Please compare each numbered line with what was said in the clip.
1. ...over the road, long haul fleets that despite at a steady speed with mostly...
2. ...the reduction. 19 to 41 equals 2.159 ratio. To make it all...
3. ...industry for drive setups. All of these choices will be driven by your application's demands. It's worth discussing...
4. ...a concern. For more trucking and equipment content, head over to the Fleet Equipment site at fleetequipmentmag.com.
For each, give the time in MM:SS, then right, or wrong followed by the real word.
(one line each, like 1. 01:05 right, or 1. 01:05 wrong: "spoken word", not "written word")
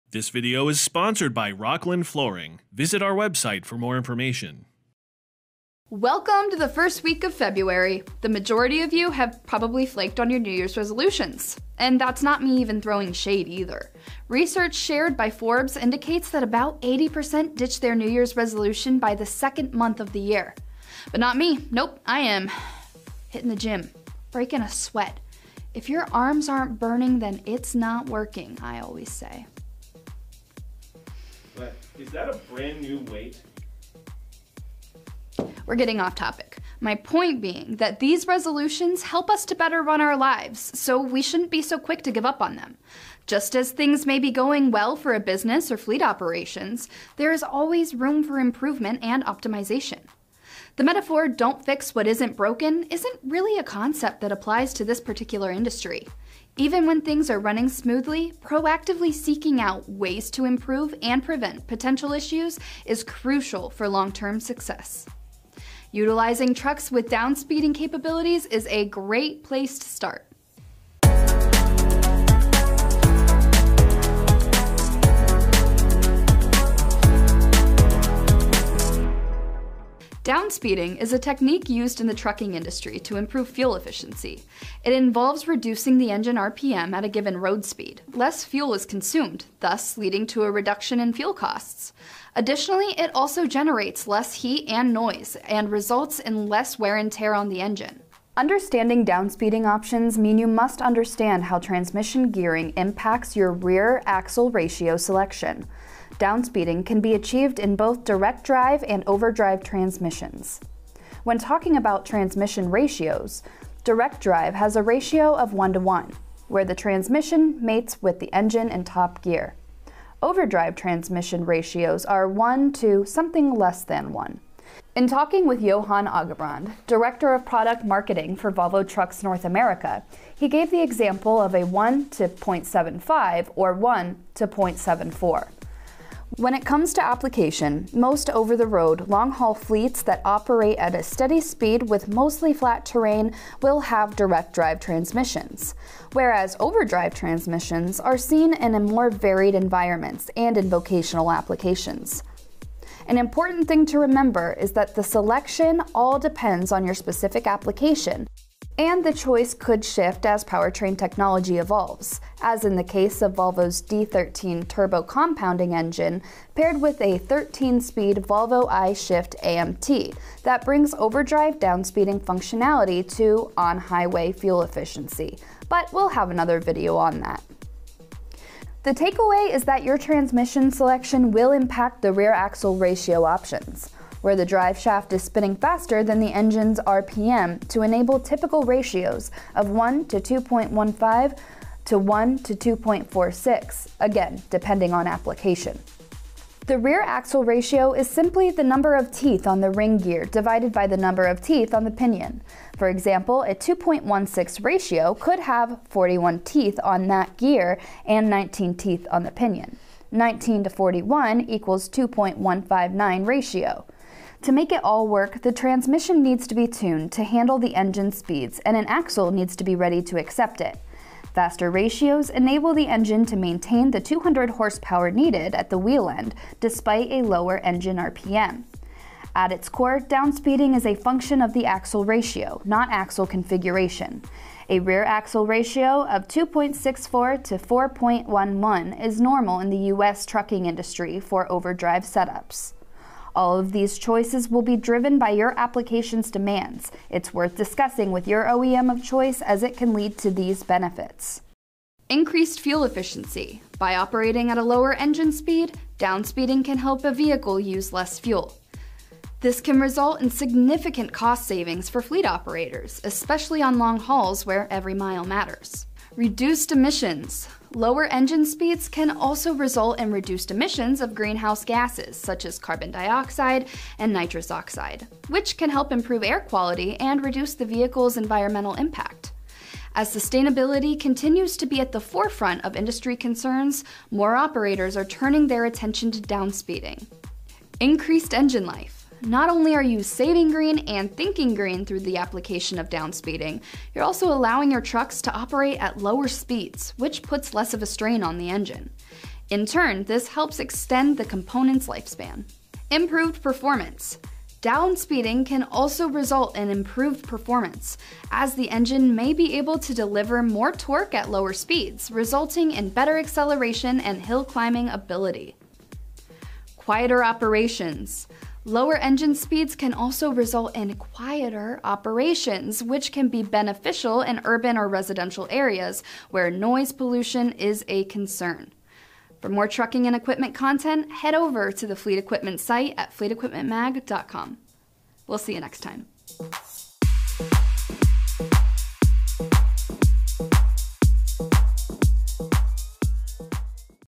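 1. 02:18 wrong: "operate", not "despite"
2. 03:29 wrong: "pinion", not "reduction"
3. 04:00 wrong: "overdrive", not "drive"
4. 05:27 right.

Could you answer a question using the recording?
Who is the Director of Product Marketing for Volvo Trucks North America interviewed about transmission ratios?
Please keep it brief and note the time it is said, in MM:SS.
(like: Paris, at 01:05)
Johan Agebrand, at 02:05.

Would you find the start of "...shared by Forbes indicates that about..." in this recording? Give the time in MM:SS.
00:14.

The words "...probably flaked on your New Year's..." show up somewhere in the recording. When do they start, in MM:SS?
00:09.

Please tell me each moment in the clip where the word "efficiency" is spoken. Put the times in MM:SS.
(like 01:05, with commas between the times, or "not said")
01:23, 02:54, 04:12.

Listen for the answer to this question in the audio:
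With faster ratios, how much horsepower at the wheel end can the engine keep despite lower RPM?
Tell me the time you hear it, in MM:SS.
03:44.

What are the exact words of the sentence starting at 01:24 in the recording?
It involves reducing the engine RPM at a given road speed.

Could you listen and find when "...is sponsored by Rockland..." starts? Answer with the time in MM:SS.
00:00.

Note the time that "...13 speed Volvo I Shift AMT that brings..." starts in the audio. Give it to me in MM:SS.
02:47.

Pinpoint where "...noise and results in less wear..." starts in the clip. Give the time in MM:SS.
01:34.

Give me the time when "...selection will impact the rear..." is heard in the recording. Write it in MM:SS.
03:00.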